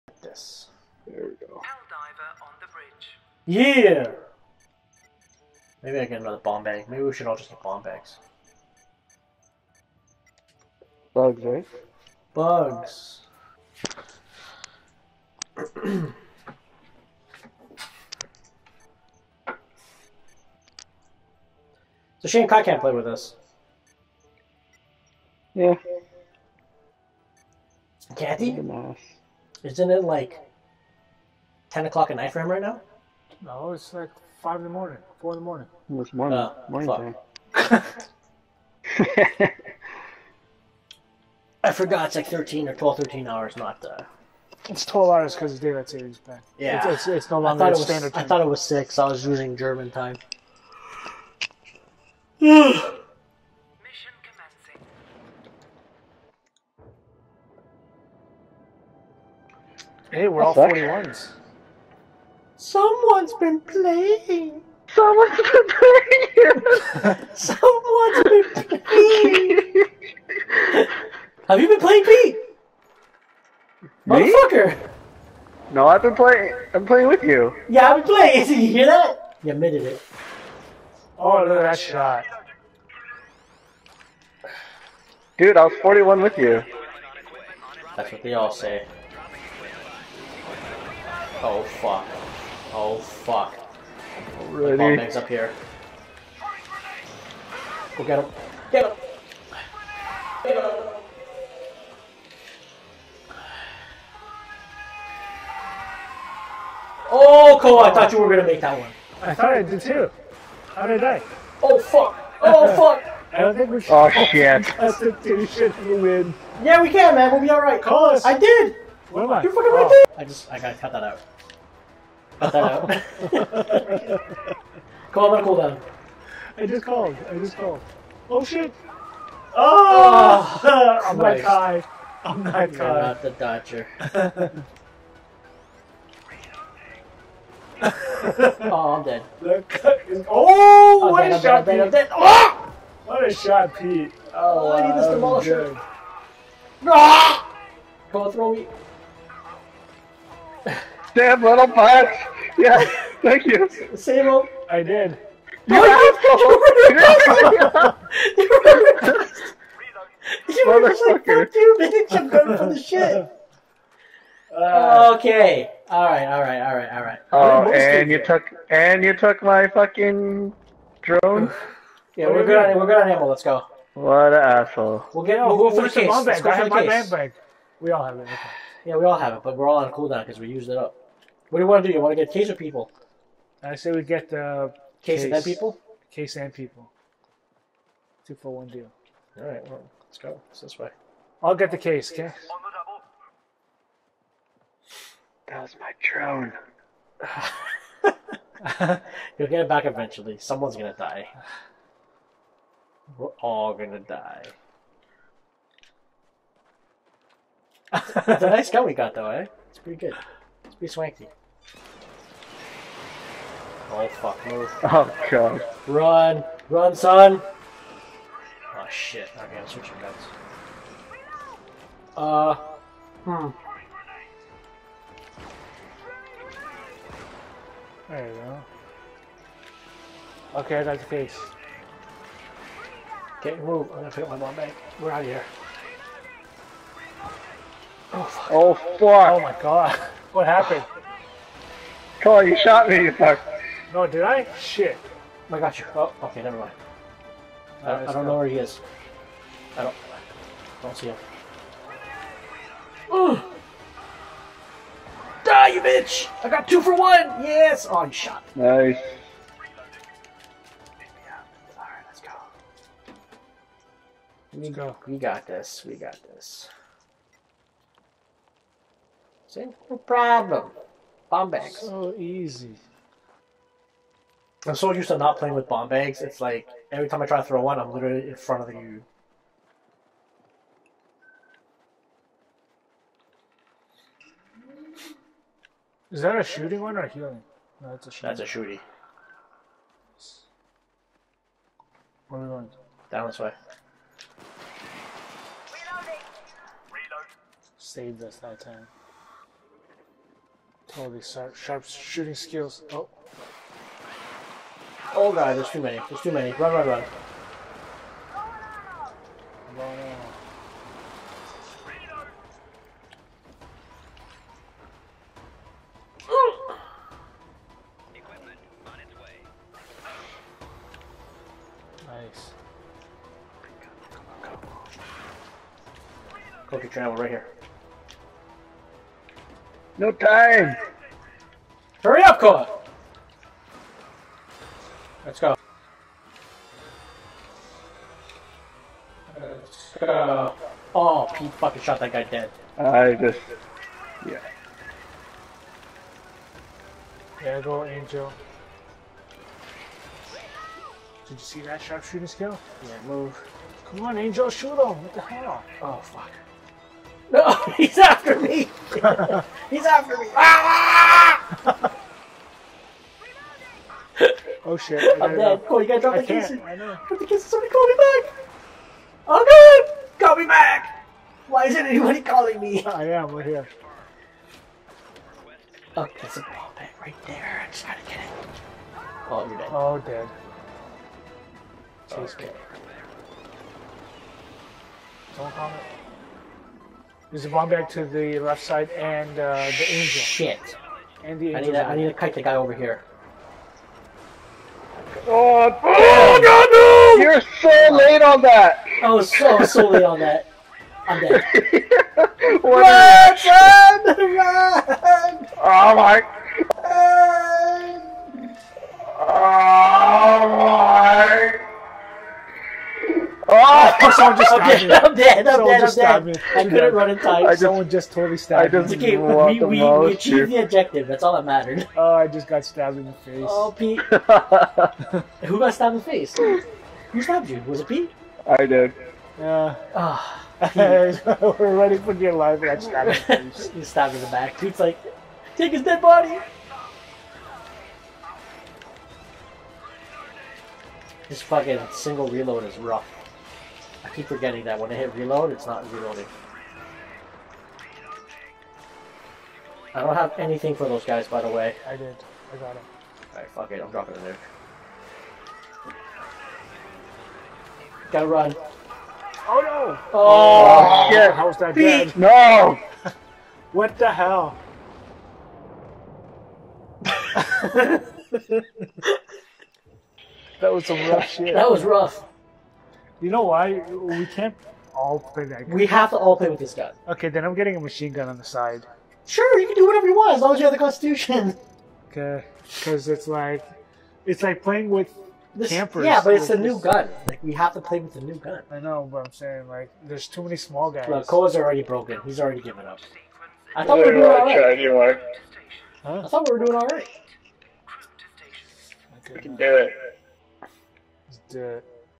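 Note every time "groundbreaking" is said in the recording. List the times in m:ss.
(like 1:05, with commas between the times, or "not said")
not said.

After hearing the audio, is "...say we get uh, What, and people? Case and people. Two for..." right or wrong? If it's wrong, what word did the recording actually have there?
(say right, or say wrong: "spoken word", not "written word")
wrong: "Case", not "What".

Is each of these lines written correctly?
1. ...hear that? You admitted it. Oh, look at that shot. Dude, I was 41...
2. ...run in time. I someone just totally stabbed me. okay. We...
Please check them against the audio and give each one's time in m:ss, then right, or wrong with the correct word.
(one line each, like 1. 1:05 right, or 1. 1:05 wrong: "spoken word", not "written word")
1. 1:18 right
2. 6:56 right.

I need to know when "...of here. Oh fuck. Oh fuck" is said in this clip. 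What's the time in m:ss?
3:55.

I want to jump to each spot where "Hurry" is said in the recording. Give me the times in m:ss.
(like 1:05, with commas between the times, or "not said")
5:32.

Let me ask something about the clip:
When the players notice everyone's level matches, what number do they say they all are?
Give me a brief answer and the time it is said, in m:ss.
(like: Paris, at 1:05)
41, at 1:00.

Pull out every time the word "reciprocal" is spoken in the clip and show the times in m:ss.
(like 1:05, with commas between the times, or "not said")
not said.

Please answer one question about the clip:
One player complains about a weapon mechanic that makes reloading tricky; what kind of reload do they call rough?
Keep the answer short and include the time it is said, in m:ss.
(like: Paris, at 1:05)
single reload, at 7:21.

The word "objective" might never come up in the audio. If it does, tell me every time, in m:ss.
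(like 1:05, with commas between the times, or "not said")
7:00.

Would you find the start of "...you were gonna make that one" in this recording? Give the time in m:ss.
1:48.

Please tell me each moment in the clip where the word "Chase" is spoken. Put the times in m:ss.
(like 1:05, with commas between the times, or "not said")
6:22.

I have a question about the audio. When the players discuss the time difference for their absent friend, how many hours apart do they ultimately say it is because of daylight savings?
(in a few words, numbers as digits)
12.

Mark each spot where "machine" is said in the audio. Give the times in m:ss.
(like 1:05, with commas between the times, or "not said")
7:57.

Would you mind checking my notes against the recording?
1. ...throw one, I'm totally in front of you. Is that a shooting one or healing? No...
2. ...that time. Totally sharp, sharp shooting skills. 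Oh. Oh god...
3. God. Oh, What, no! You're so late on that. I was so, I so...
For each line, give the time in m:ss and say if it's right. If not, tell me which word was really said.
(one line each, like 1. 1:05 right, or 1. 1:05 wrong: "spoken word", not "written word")
1. 4:37 wrong: "literally", not "totally"
2. 4:58 right
3. 6:35 wrong: "God", not "What".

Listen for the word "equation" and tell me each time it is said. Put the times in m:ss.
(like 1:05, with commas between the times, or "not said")
not said.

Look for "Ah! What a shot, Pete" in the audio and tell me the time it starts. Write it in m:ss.
2:22.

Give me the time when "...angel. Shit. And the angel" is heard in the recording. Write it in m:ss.
6:29.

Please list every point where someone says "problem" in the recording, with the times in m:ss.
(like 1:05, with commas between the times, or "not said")
4:29.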